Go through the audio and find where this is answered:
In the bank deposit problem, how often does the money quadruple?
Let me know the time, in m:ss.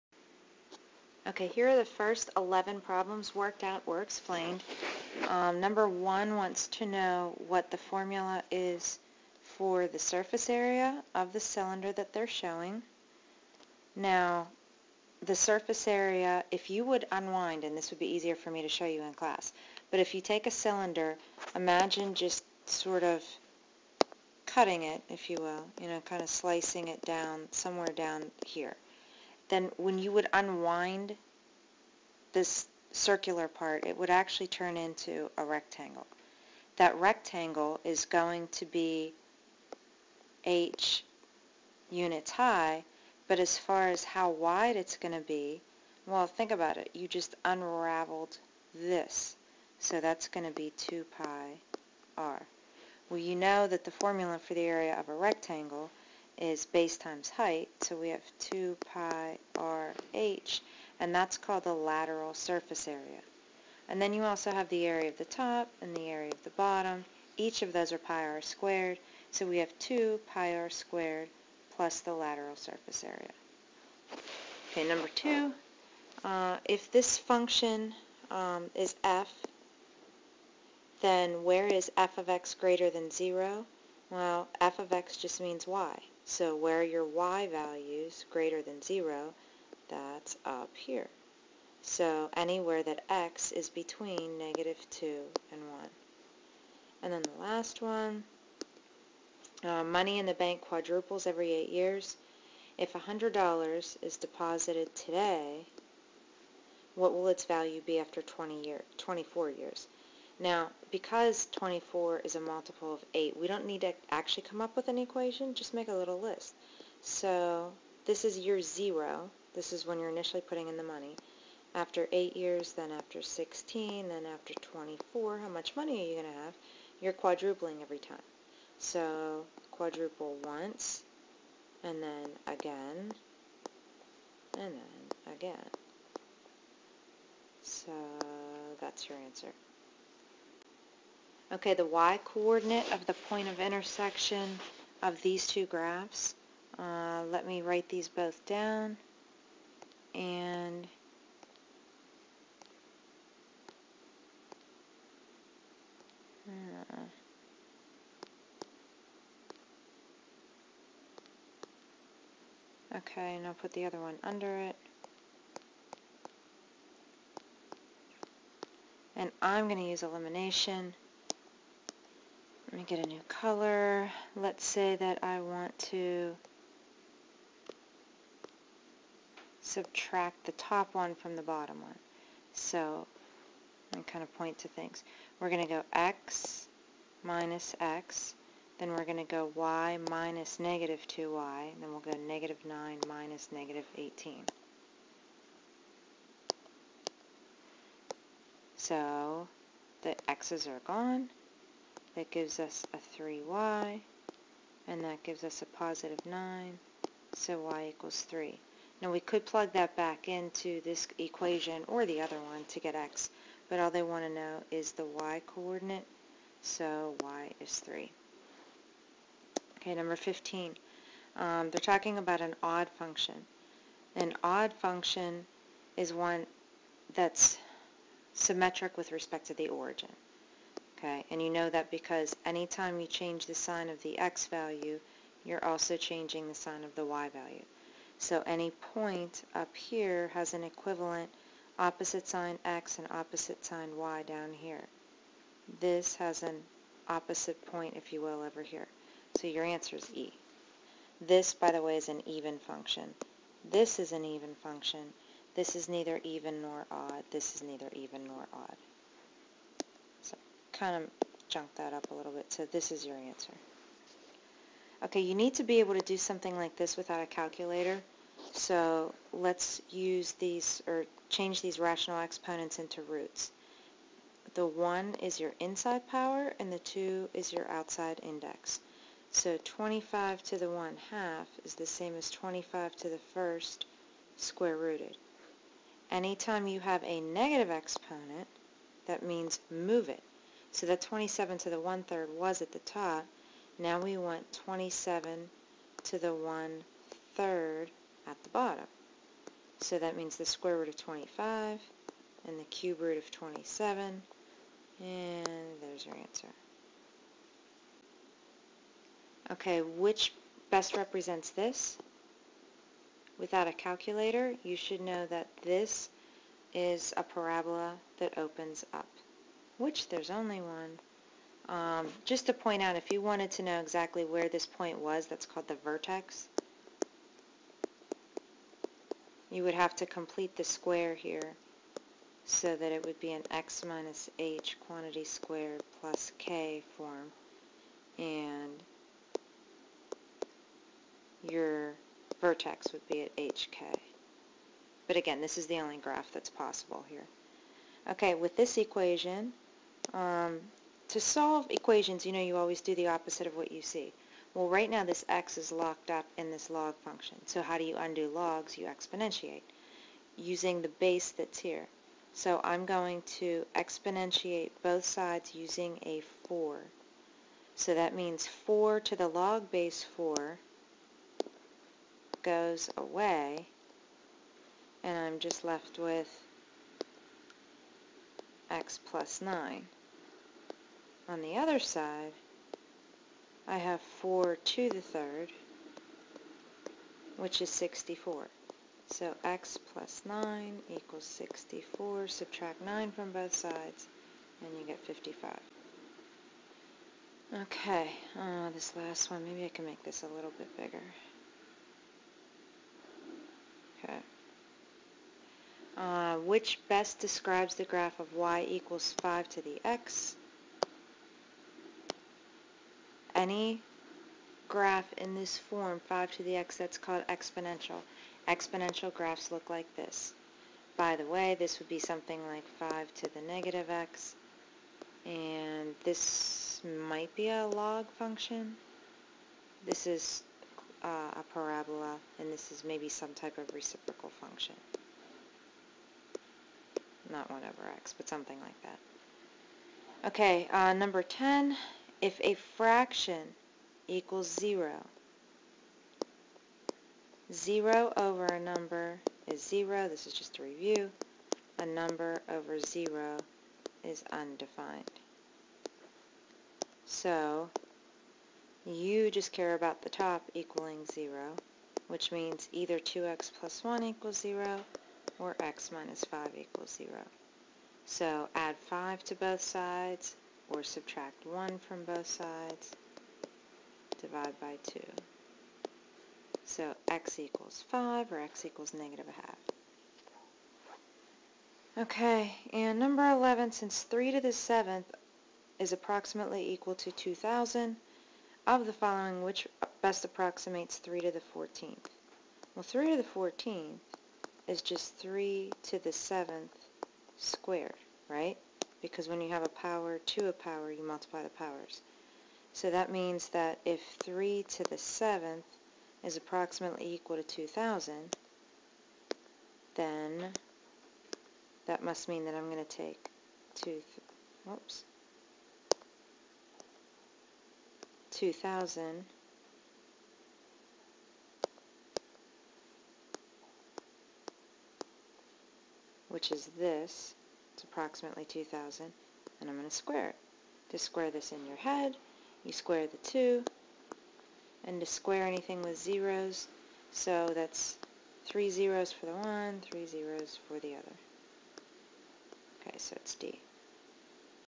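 1:41.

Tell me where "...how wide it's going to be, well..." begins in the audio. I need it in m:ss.
0:44.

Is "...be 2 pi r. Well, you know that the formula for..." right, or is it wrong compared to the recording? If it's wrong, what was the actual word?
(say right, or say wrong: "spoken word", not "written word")
right.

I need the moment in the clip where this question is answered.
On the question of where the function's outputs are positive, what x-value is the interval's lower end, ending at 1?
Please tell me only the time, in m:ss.
1:34.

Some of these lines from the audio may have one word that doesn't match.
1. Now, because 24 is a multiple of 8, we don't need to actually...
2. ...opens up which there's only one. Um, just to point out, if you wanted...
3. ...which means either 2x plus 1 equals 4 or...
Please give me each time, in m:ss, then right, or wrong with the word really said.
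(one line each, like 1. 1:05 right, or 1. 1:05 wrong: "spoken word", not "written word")
1. 1:50 right
2. 5:18 right
3. 7:42 wrong: "0", not "4".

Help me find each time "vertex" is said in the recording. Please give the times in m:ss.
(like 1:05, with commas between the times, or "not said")
5:25, 5:42.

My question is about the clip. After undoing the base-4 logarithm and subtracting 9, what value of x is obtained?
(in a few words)
55.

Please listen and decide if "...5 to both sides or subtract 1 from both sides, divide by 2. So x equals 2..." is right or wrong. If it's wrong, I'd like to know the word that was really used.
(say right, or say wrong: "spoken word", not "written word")
wrong: "5", not "2".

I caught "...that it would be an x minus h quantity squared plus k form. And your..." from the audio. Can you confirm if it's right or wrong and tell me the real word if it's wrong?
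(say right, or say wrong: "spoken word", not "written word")
right.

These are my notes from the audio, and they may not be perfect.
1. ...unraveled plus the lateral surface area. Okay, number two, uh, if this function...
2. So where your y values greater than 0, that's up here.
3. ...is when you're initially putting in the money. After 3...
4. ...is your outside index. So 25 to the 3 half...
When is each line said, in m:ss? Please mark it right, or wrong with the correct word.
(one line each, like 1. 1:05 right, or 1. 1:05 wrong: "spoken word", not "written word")
1. 1:10 wrong: "squared", not "unraveled"
2. 1:26 right
3. 1:59 wrong: "8", not "3"
4. 4:37 wrong: "1", not "3".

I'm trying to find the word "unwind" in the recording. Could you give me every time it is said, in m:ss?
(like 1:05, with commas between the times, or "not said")
0:17, 0:30.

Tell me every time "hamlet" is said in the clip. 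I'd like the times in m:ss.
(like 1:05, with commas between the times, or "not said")
not said.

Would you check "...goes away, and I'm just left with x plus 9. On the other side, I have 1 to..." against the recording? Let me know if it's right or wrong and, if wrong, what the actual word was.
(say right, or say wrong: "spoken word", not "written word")
wrong: "4", not "1".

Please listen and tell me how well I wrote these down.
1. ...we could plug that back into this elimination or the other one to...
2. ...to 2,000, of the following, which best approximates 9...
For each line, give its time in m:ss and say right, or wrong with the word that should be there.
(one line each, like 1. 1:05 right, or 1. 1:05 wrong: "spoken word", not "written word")
1. 3:29 wrong: "equation", not "elimination"
2. 8:06 wrong: "3", not "9".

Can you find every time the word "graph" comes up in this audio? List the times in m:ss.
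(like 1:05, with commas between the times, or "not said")
2:25, 5:45, 6:47, 6:54, 6:59.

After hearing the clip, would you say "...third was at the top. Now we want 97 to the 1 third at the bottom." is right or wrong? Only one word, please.
wrong.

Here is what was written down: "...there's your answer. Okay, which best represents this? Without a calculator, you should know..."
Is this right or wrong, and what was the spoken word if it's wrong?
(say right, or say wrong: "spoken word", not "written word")
right.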